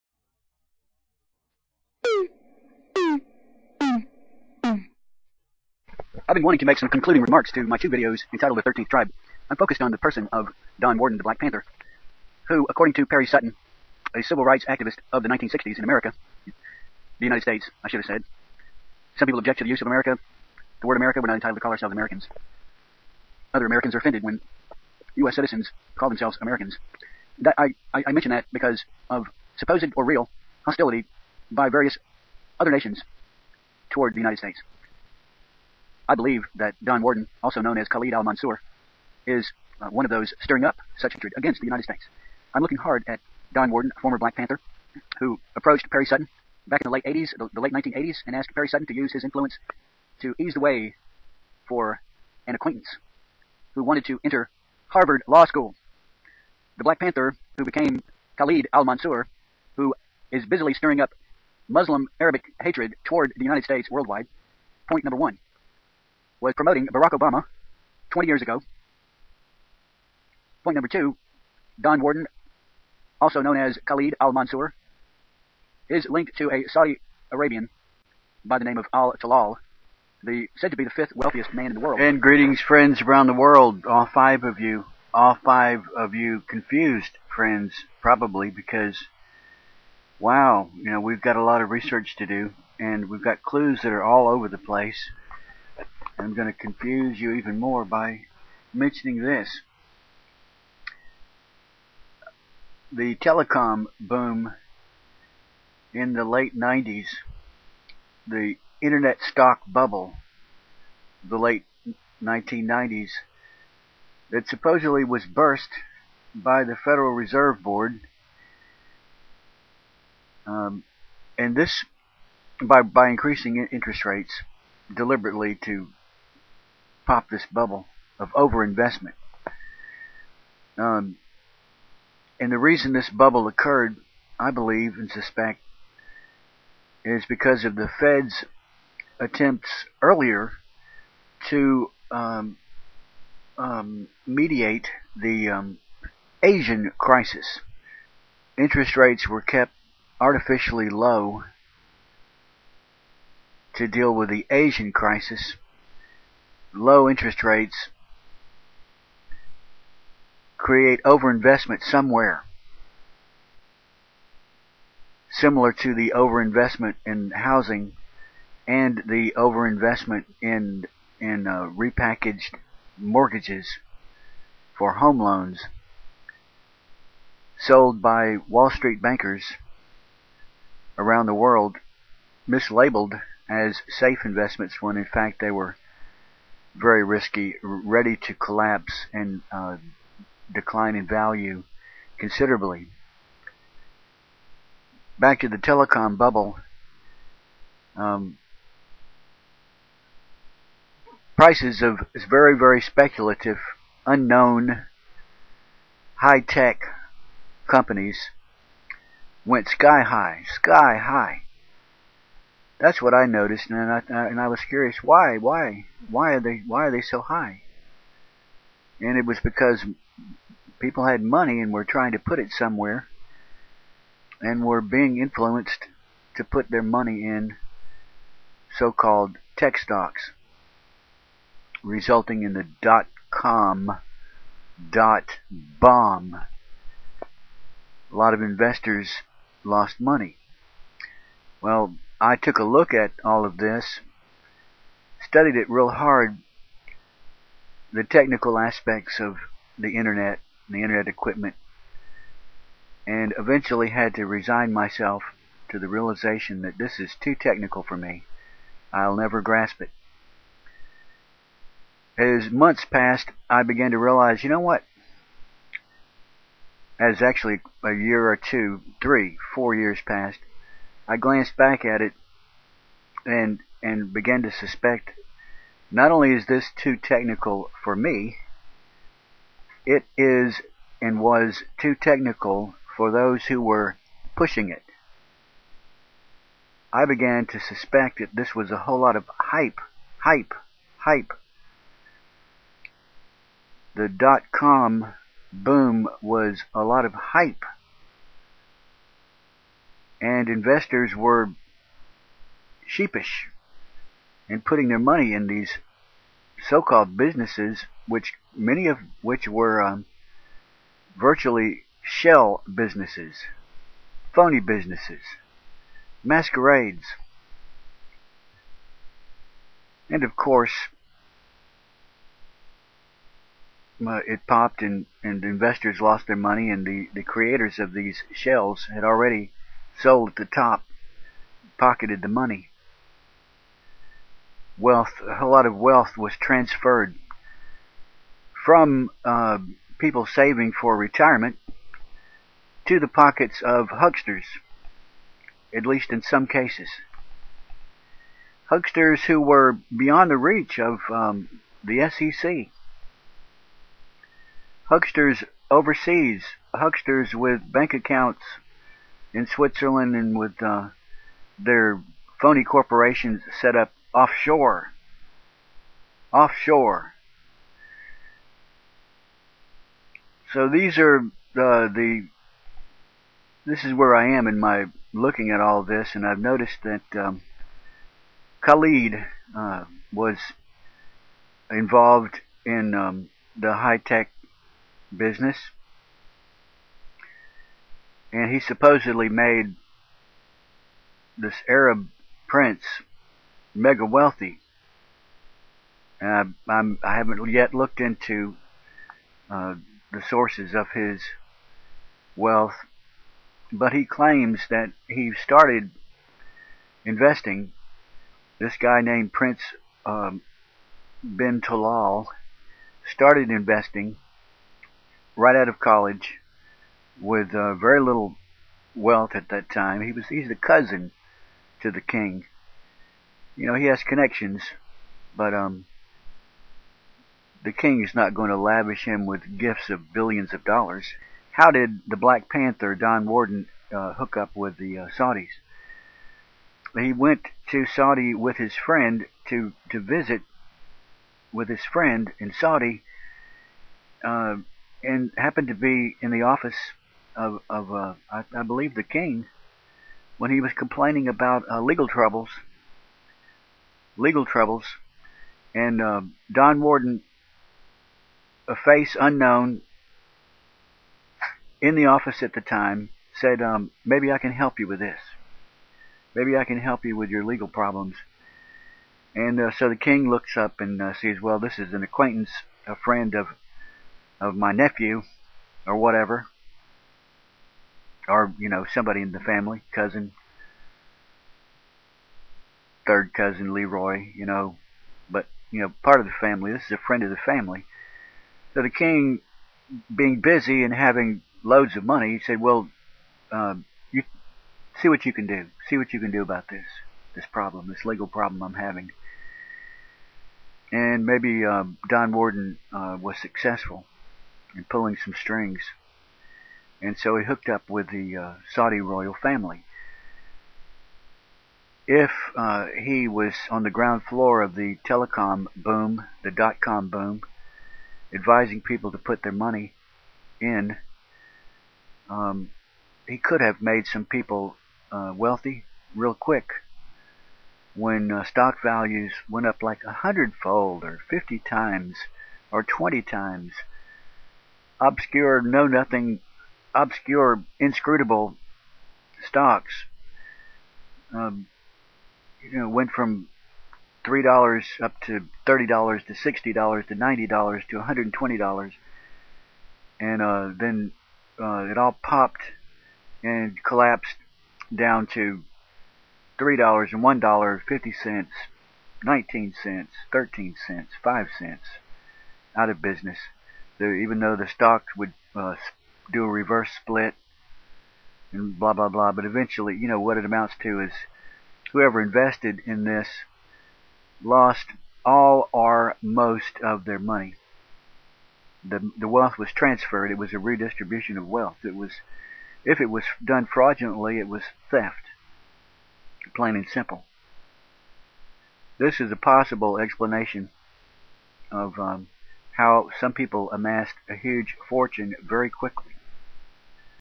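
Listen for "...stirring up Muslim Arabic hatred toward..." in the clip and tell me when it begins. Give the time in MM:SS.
01:00.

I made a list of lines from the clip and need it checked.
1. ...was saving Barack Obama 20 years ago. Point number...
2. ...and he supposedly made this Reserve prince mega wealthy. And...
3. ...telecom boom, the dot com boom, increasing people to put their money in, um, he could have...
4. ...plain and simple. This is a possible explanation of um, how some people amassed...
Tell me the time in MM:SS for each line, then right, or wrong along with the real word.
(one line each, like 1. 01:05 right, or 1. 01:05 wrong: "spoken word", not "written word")
1. 01:06 wrong: "promoting", not "saving"
2. 06:28 wrong: "Arab", not "Reserve"
3. 08:35 wrong: "advising", not "increasing"
4. 09:46 right.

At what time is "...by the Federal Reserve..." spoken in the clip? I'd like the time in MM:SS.
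01:56.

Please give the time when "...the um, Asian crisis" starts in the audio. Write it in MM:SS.
02:25.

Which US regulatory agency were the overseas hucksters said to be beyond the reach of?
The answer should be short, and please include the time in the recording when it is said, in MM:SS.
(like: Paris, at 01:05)
the SEC, at 05:52.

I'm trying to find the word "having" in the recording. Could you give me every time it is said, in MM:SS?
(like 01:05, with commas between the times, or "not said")
08:10, 08:18.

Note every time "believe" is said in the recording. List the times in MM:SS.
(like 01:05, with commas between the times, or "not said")
00:36, 02:14, 07:28.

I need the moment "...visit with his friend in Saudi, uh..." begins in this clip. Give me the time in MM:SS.
07:19.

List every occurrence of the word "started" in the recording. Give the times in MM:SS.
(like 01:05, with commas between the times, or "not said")
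06:45, 06:53.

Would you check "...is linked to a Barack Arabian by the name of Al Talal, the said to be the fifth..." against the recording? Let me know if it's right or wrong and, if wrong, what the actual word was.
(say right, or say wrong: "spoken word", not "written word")
wrong: "Saudi", not "Barack".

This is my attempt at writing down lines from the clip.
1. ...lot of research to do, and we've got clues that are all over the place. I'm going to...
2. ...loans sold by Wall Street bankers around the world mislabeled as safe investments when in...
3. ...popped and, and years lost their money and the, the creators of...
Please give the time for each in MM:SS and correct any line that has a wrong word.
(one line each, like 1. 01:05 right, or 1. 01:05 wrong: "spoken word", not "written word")
1. 01:31 right
2. 02:55 right
3. 05:24 wrong: "investors", not "years".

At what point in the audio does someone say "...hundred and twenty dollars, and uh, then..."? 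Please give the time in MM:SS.
09:08.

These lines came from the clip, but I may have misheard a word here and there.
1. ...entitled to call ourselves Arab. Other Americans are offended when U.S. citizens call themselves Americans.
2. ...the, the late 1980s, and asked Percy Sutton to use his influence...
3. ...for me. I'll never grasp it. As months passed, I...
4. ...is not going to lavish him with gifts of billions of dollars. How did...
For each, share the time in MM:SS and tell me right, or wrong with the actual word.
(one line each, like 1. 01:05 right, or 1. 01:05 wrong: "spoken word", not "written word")
1. 00:21 wrong: "Americans", not "Arab"
2. 00:47 right
3. 04:17 right
4. 07:08 right.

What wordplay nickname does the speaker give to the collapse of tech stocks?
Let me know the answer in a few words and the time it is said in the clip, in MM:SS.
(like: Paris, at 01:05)
dot bomb, at 03:54.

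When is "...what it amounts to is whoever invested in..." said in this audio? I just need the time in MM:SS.
09:30.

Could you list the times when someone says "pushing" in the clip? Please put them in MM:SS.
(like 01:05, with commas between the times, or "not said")
04:44.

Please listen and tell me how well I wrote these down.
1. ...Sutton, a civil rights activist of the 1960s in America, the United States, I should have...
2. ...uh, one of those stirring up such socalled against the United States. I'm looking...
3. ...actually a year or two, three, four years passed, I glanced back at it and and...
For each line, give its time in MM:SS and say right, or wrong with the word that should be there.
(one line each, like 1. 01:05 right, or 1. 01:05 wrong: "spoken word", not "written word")
1. 00:13 right
2. 00:39 wrong: "hatred", not "socalled"
3. 04:27 right.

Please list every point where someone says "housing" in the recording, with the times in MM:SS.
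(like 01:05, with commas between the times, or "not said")
02:47.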